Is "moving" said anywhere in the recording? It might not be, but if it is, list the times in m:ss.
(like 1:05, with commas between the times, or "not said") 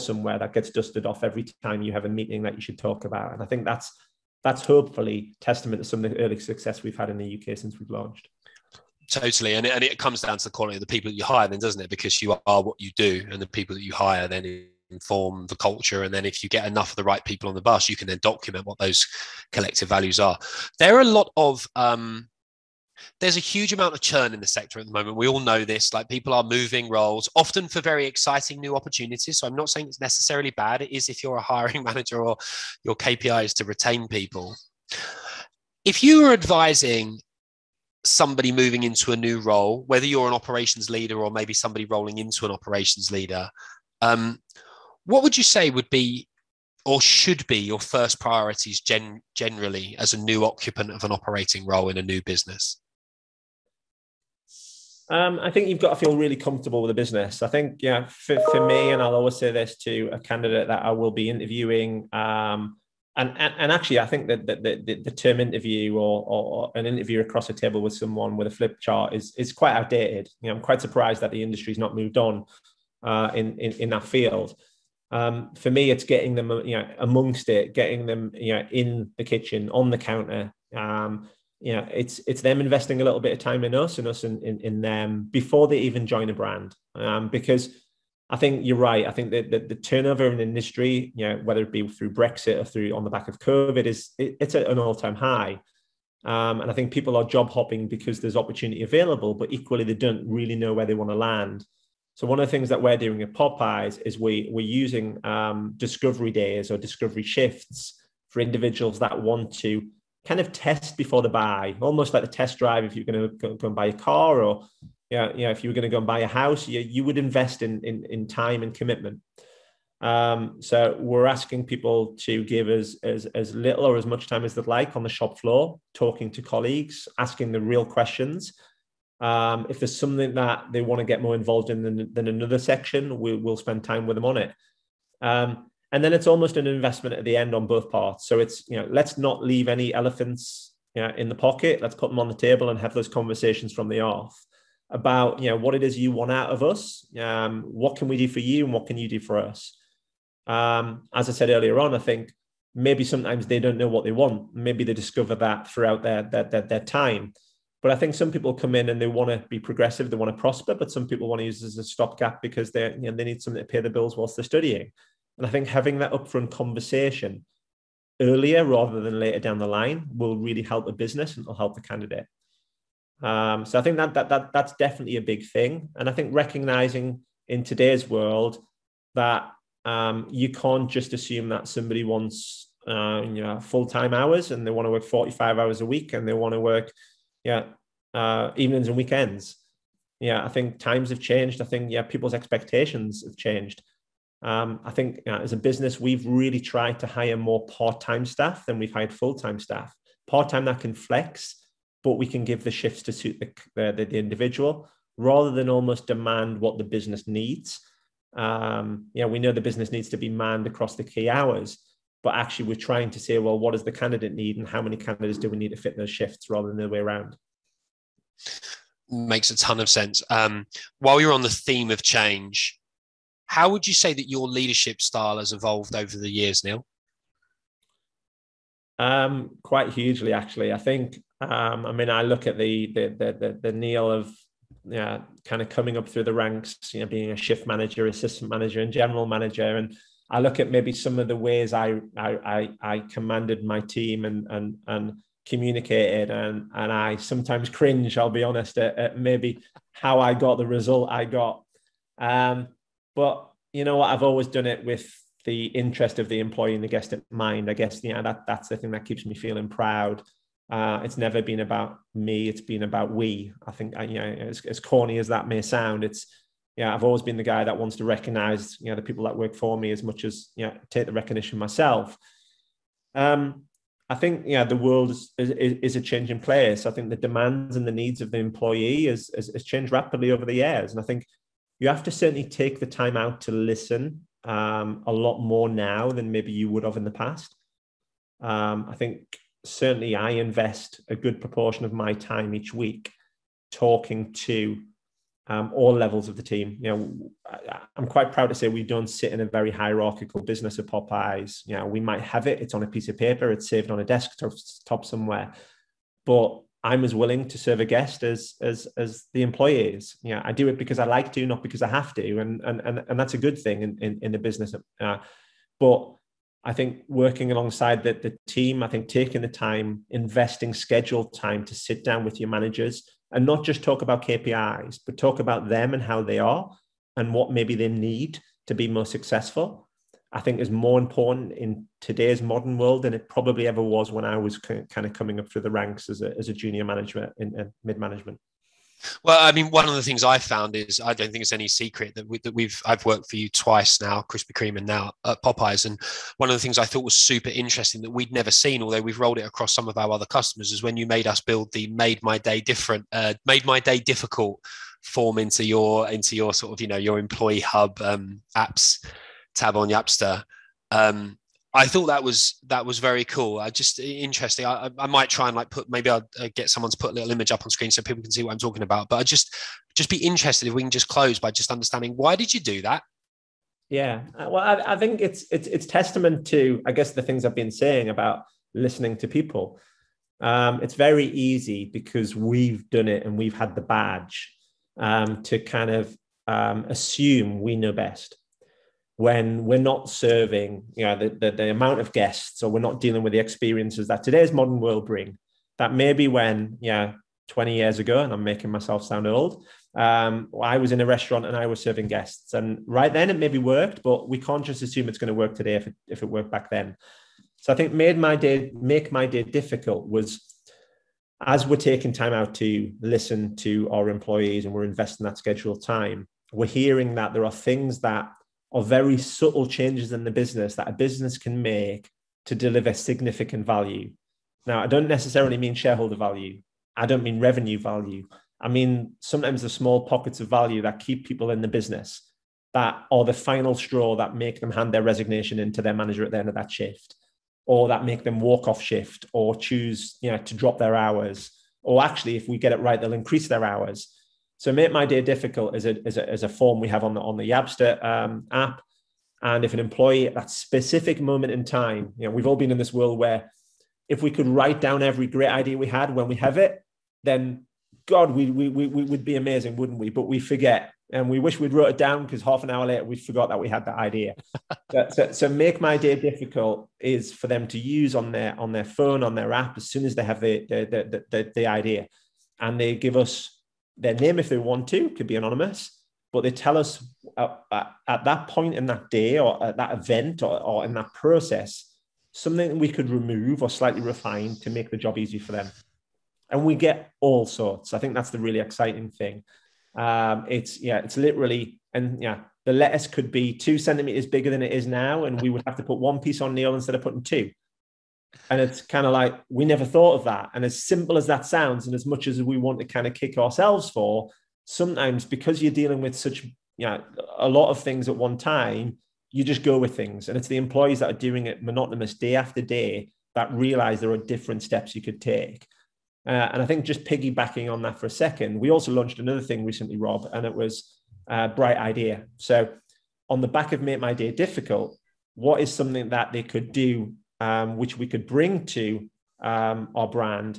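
0:26, 0:38.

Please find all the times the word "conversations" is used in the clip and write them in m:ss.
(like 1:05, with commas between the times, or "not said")
2:23, 2:46.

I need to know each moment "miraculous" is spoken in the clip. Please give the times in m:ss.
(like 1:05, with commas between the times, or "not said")
not said.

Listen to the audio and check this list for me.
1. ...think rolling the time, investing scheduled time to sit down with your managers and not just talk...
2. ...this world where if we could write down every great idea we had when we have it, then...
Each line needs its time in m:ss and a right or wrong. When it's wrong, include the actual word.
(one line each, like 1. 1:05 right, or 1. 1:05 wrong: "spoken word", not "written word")
1. 5:18 wrong: "taking", not "rolling"
2. 7:32 right.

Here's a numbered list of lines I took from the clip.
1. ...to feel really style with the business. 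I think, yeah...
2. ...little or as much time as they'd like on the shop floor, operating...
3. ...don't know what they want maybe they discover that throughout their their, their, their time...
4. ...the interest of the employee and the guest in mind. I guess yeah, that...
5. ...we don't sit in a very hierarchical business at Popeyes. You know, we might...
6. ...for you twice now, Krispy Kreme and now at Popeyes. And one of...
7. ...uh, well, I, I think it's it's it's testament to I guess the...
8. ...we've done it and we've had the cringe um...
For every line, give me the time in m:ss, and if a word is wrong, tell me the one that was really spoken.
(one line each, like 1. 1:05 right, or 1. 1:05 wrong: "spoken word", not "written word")
1. 0:55 wrong: "comfortable", not "style"
2. 2:03 wrong: "talking", not "operating"
3. 2:33 right
4. 4:15 right
5. 4:58 right
6. 5:43 right
7. 6:14 right
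8. 6:22 wrong: "badge", not "cringe".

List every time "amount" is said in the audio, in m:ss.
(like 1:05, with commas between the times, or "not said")
0:23, 6:31.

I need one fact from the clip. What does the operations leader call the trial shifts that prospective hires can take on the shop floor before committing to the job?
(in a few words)
Discovery shifts.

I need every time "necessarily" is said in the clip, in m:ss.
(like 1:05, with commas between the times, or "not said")
0:30, 7:05.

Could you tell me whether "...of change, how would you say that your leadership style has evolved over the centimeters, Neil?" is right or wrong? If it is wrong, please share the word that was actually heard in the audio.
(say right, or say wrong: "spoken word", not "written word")
wrong: "years", not "centimeters".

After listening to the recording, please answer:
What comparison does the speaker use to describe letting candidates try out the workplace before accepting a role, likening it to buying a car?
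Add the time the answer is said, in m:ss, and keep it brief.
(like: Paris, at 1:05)
Test drive, at 1:52.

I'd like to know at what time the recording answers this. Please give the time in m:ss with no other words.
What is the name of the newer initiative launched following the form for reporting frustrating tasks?
8:41.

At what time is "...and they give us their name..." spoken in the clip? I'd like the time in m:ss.
7:52.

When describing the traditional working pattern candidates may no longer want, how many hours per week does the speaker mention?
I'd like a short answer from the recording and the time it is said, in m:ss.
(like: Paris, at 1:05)
45, at 3:05.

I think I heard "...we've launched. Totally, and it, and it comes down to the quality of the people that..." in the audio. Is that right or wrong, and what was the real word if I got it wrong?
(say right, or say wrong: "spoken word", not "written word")
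right.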